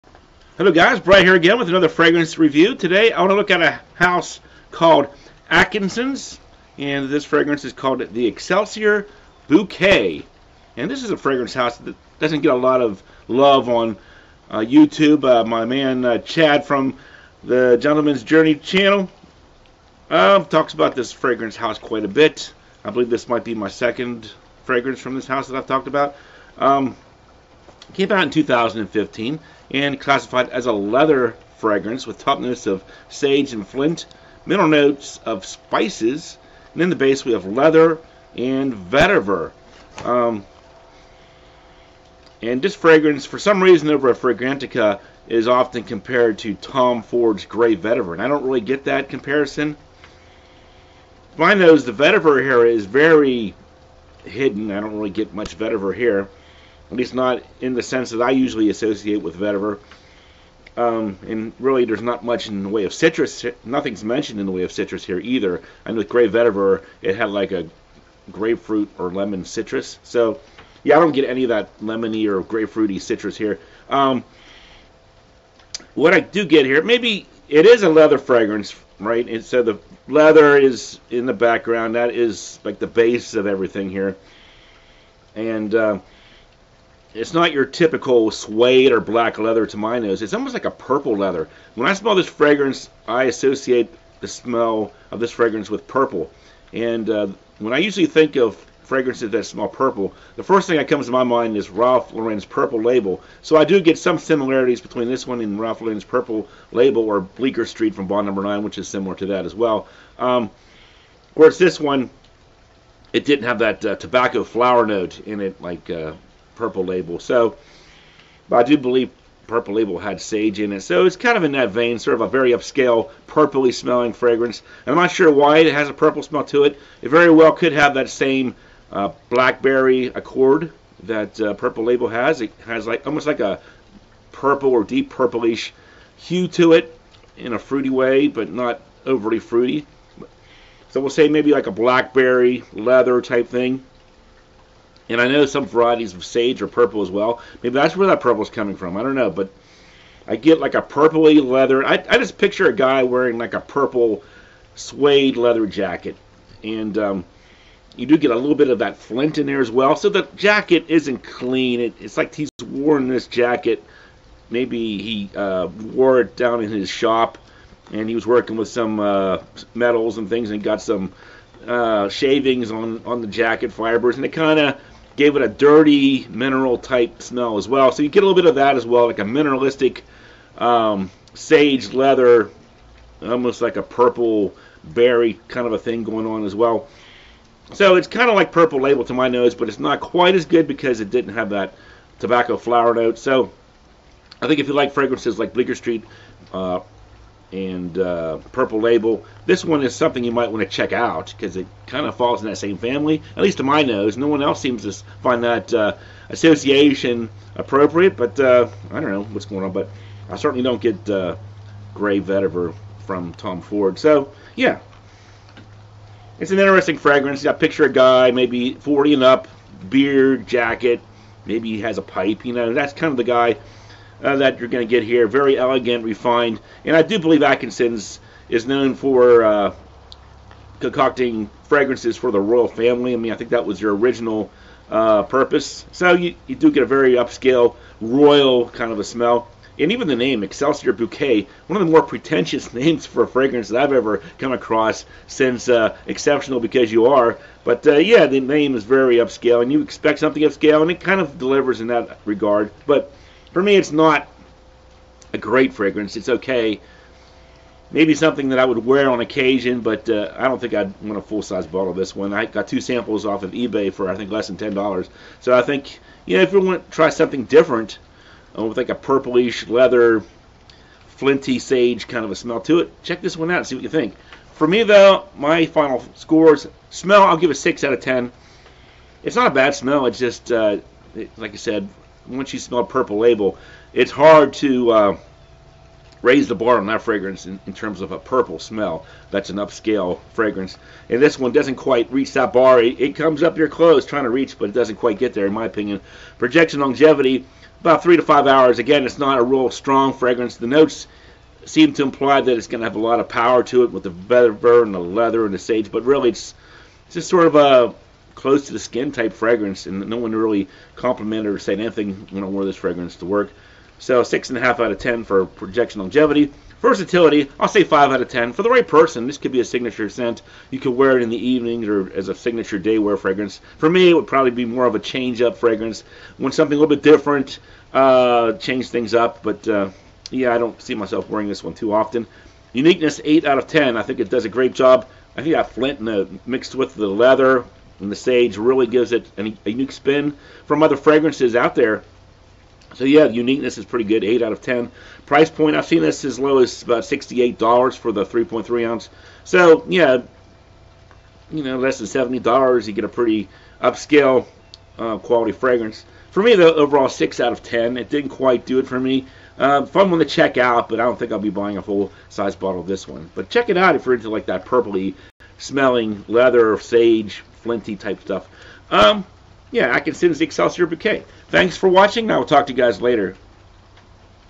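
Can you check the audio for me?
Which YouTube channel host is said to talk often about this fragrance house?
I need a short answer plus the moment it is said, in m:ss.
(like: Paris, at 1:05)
Gentleman's Journey, at 0:17.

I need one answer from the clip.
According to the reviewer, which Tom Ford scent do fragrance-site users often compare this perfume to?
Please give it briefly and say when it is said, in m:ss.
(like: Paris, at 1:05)
Grey Vetiver, at 0:46.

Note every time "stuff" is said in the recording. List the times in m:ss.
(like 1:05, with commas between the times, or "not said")
6:08.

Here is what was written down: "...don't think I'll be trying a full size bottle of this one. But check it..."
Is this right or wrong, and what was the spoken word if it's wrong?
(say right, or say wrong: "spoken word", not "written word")
wrong: "buying", not "trying".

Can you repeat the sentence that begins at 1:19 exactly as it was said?
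And so the leather is in the background.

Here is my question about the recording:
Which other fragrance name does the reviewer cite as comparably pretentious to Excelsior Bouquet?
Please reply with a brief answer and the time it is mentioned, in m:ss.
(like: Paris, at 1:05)
Exceptional Because You Are, at 4:06.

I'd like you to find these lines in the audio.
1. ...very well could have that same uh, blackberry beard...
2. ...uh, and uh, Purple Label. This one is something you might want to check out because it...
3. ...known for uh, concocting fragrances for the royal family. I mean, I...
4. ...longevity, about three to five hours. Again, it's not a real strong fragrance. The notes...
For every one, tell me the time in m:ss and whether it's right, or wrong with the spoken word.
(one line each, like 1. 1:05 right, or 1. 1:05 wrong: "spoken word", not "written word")
1. 2:07 wrong: "accord", not "beard"
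2. 3:16 right
3. 3:48 right
4. 4:56 right.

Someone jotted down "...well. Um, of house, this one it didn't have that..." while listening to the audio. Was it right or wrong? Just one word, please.
wrong.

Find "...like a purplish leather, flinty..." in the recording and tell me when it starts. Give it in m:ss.
4:28.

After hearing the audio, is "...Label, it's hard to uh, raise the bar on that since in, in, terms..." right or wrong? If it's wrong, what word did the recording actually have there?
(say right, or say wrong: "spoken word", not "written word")
wrong: "fragrance", not "since".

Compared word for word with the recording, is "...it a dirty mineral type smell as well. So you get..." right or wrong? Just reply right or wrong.
right.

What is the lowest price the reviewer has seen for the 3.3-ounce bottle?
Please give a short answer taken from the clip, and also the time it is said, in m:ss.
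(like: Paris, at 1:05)
$68, at 5:47.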